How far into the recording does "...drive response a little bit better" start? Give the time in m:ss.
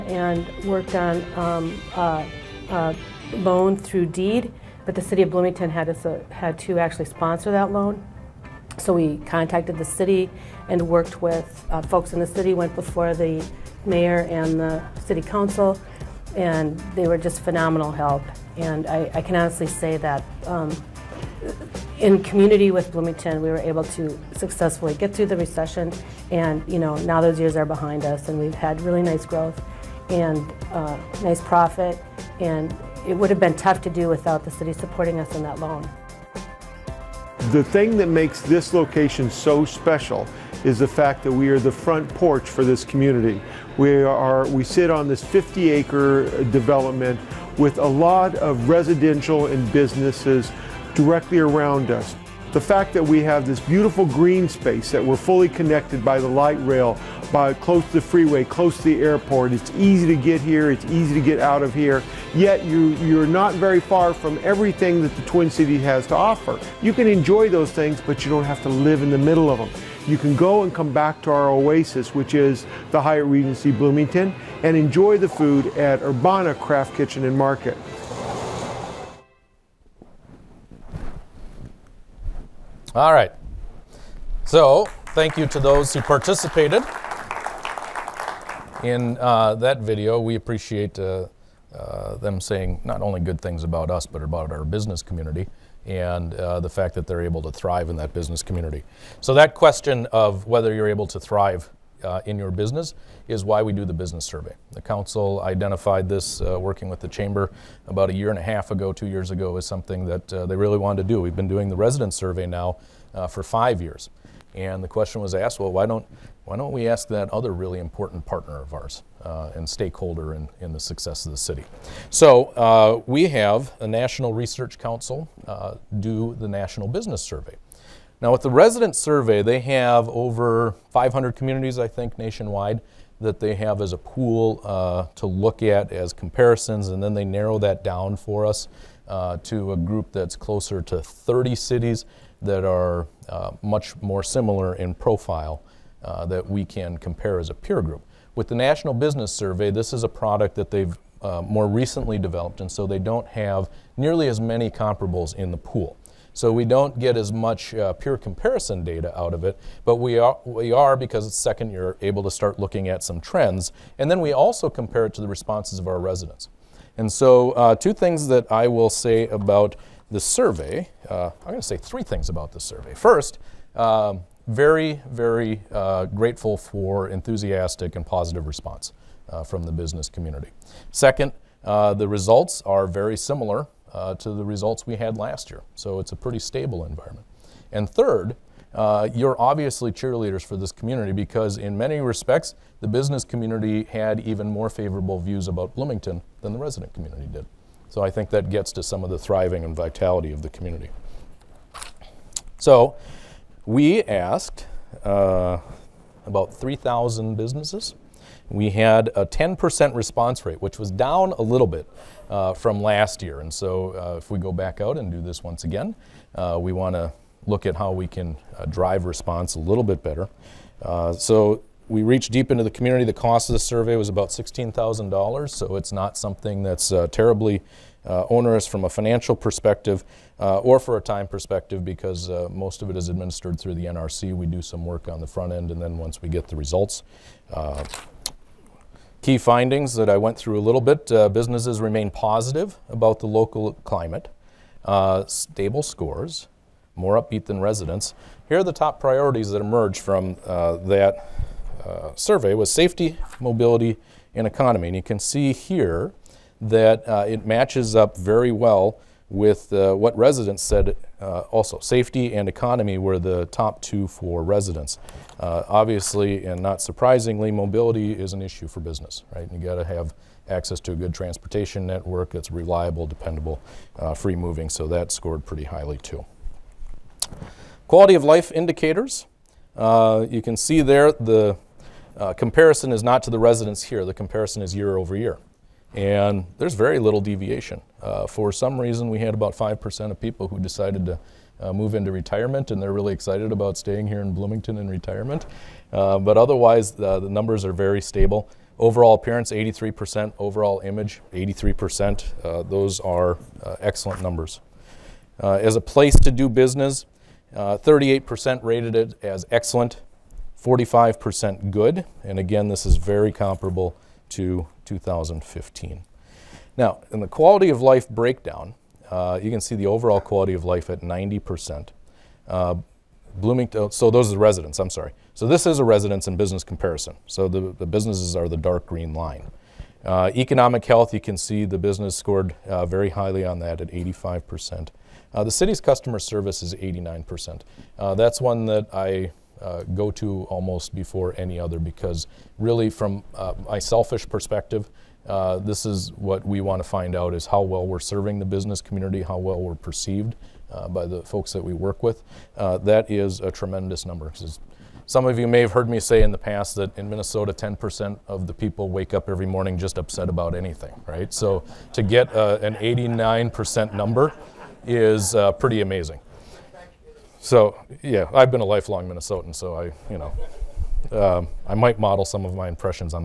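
3:38.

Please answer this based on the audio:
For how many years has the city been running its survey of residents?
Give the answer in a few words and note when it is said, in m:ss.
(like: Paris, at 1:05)
5 years, at 1:53.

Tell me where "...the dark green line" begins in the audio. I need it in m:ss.
5:28.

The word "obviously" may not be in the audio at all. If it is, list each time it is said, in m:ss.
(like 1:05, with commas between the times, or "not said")
3:09, 4:25.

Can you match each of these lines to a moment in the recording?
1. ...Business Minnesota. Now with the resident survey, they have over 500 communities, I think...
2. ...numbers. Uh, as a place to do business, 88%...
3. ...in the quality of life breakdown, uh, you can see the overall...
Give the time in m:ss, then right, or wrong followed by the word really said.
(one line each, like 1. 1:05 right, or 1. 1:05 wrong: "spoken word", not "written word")
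1. 2:06 wrong: "Survey", not "Minnesota"
2. 5:04 wrong: "38", not "88"
3. 5:17 right.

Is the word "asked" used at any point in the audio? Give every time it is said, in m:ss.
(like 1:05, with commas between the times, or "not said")
1:55, 3:24.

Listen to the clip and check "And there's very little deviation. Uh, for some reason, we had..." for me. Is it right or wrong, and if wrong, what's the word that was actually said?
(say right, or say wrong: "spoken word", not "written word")
right.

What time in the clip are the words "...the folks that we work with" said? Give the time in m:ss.
5:51.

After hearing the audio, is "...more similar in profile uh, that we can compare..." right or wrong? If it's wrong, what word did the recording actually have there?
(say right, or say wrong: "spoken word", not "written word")
right.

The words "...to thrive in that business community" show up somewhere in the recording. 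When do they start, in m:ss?
1:37.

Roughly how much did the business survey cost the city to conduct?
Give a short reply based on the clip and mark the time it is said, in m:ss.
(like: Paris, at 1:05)
$16,000, at 3:44.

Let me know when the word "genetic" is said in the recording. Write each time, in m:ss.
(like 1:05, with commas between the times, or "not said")
not said.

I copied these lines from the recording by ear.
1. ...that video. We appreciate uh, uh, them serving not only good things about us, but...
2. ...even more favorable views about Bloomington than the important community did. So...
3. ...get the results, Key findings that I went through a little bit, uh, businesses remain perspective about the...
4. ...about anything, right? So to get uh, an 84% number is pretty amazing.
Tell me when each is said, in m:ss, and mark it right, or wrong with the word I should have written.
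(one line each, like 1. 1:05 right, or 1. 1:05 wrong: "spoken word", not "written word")
1. 1:29 wrong: "saying", not "serving"
2. 3:14 wrong: "resident", not "important"
3. 3:56 wrong: "positive", not "perspective"
4. 6:00 wrong: "89", not "84".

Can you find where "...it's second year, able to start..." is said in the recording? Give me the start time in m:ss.
2:41.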